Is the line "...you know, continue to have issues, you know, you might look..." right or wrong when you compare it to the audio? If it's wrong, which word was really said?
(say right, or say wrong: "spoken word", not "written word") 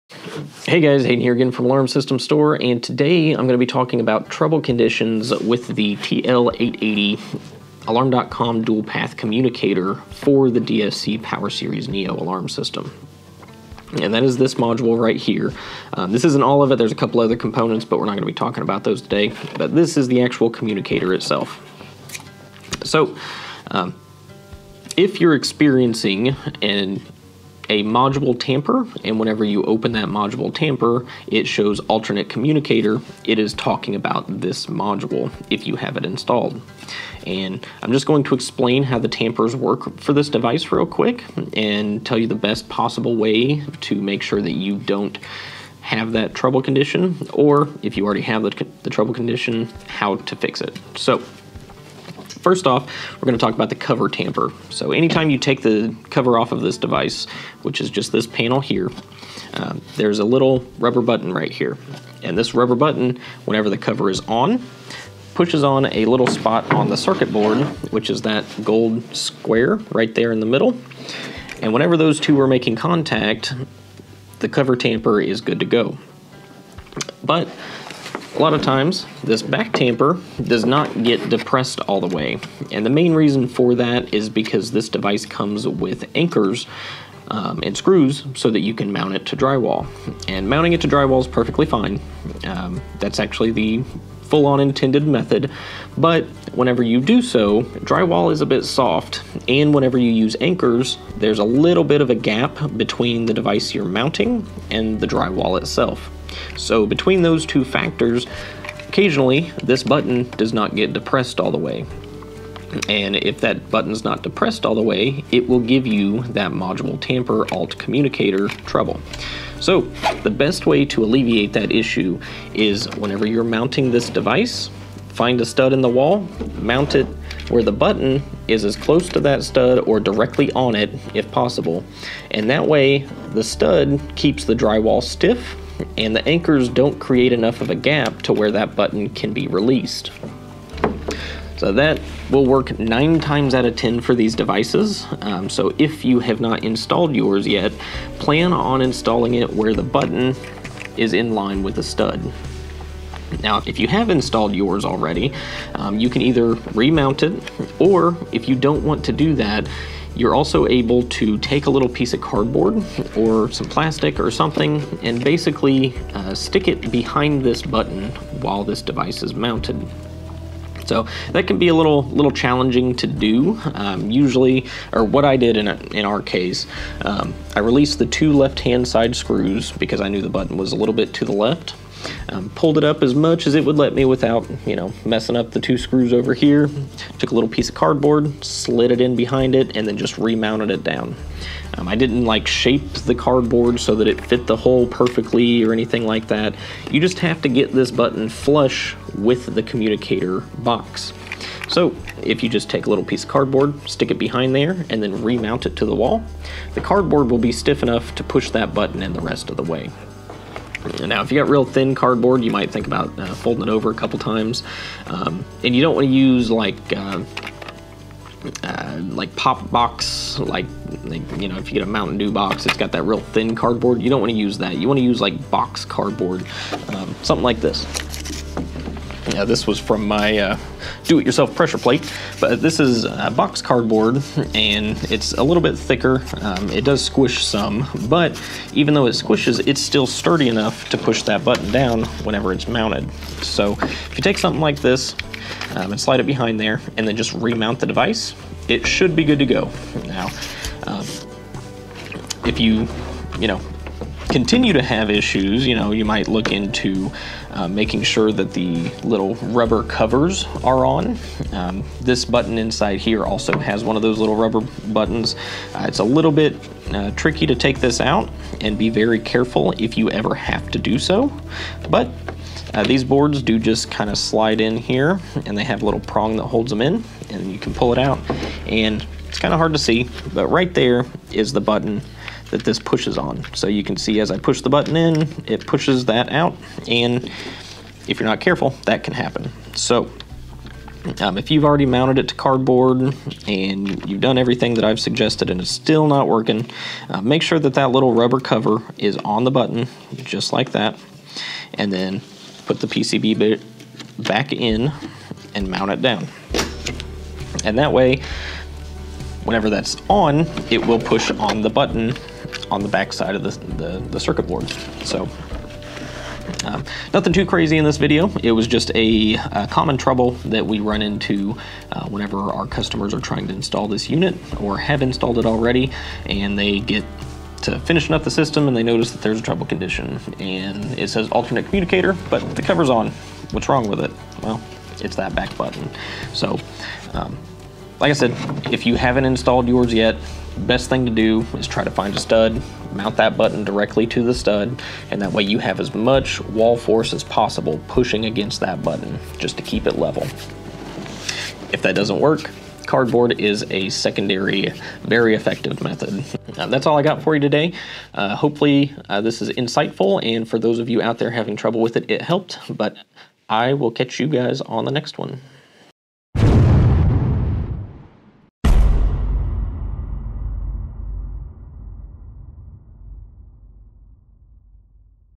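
right.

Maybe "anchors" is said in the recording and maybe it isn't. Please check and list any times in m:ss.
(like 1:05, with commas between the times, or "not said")
1:26, 1:40, 2:16.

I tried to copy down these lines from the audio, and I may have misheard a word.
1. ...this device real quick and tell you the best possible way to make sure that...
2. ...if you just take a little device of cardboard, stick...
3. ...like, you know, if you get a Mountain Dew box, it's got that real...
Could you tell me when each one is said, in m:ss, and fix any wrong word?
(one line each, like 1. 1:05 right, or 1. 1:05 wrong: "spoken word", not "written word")
1. 0:40 right
2. 3:22 wrong: "piece", not "device"
3. 3:41 right.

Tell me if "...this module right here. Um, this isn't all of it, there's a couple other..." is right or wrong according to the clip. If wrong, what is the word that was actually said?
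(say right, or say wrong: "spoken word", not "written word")
right.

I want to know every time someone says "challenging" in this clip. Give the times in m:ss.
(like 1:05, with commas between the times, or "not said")
2:52.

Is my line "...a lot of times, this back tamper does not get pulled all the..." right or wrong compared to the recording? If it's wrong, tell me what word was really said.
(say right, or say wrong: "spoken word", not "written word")
wrong: "depressed", not "pulled".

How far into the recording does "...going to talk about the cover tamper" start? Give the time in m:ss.
0:53.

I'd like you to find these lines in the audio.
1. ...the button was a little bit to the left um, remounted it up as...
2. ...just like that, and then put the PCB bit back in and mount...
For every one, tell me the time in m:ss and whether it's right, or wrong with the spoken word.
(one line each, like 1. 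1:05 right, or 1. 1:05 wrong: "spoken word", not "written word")
1. 3:00 wrong: "pulled", not "remounted"
2. 5:00 right.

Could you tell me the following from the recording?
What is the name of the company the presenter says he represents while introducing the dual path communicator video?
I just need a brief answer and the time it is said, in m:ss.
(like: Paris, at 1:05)
Alarm System Store, at 0:01.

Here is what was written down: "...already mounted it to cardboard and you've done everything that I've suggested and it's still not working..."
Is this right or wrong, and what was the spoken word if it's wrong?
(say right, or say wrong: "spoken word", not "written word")
right.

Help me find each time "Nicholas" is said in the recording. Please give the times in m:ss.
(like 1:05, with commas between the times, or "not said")
not said.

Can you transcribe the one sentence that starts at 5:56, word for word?
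Uh, that's all I got for you today.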